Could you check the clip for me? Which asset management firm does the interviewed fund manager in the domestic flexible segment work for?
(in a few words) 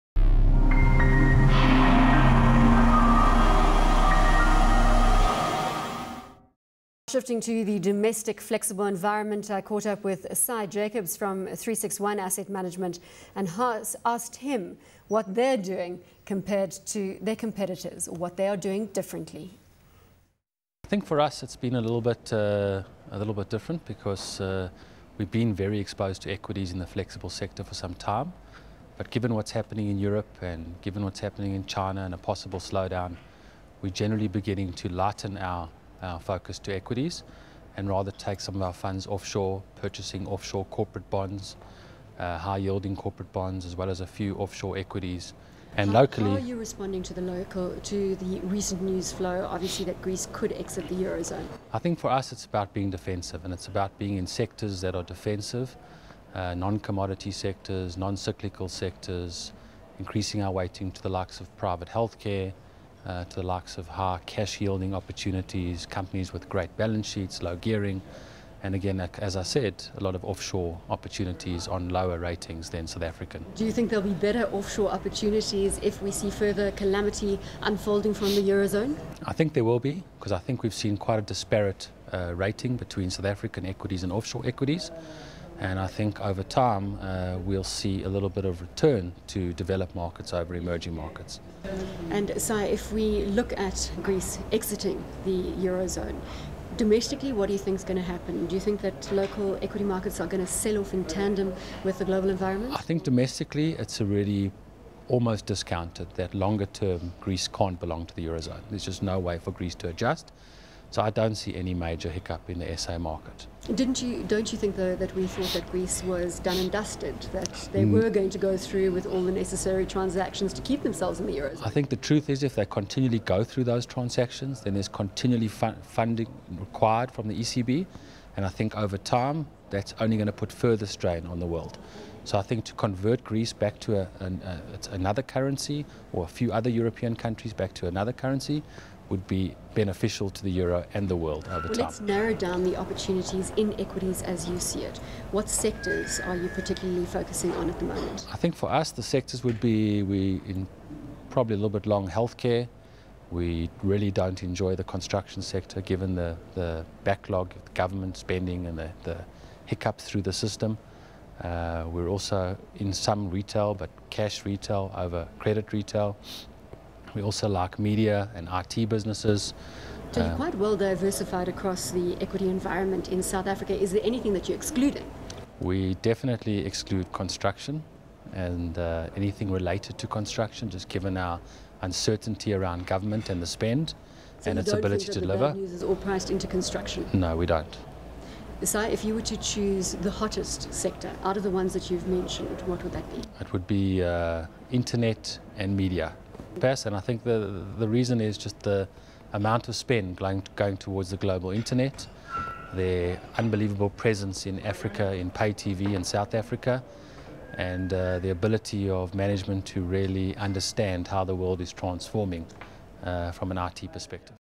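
36One Asset Management.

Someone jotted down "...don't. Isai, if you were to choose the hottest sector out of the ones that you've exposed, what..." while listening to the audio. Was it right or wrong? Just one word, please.
wrong.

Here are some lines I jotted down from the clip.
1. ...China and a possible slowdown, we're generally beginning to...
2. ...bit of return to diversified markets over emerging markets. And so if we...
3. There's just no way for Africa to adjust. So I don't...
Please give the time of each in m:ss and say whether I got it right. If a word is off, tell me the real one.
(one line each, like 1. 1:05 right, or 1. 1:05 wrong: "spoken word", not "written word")
1. 0:31 right
2. 1:28 wrong: "developed", not "diversified"
3. 1:48 wrong: "Greece", not "Africa".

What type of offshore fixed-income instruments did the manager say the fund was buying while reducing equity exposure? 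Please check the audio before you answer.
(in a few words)
high yielding corporate bonds.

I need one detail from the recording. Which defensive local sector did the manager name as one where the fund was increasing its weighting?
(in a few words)
private healthcare.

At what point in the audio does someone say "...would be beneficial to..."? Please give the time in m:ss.
2:19.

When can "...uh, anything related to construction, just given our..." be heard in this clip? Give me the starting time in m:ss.
2:58.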